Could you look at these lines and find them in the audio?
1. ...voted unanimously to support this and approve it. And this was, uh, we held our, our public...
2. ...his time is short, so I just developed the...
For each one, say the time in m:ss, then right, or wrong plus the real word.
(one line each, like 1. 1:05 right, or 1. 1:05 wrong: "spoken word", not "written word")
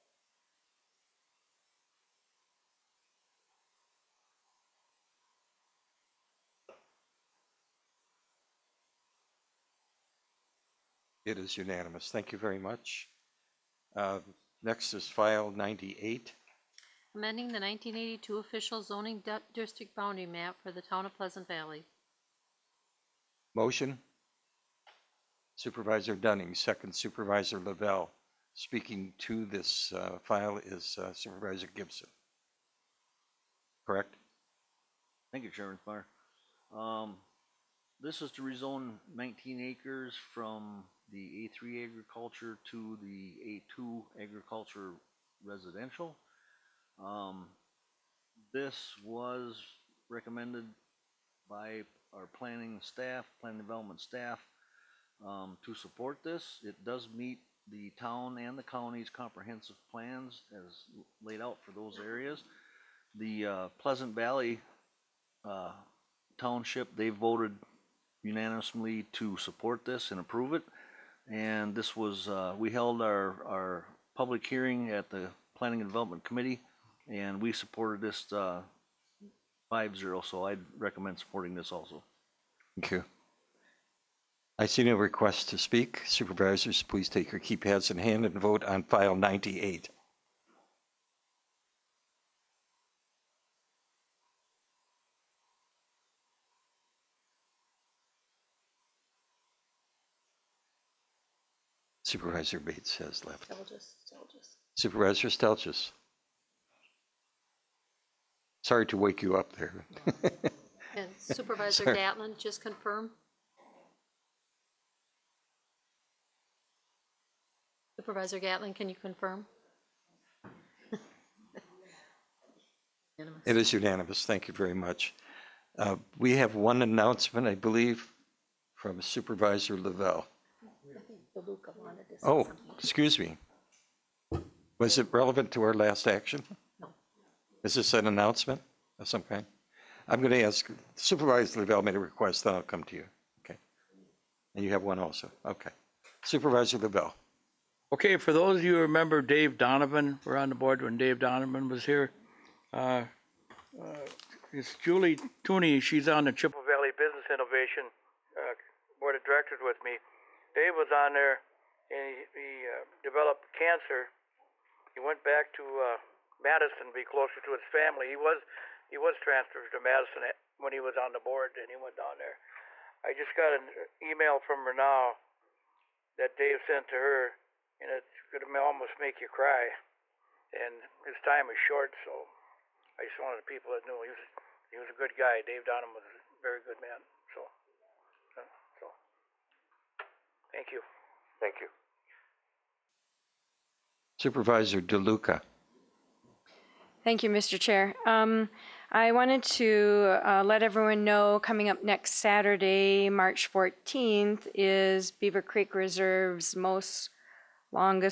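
1. 1:07 right
2. 3:01 wrong: "wanted", not "developed".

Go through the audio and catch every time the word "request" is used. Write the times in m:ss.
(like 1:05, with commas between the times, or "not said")
1:24, 2:21.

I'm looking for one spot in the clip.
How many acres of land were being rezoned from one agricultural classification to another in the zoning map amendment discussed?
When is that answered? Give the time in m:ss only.
0:39.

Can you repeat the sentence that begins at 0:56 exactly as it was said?
It does meet the town and the county's comprehensive plans as laid out for those areas.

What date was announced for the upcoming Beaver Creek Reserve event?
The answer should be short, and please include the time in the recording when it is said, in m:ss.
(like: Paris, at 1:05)
March 14th, at 3:23.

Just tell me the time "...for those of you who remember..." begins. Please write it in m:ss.
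2:28.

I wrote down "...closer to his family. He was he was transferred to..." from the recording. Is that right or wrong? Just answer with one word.
right.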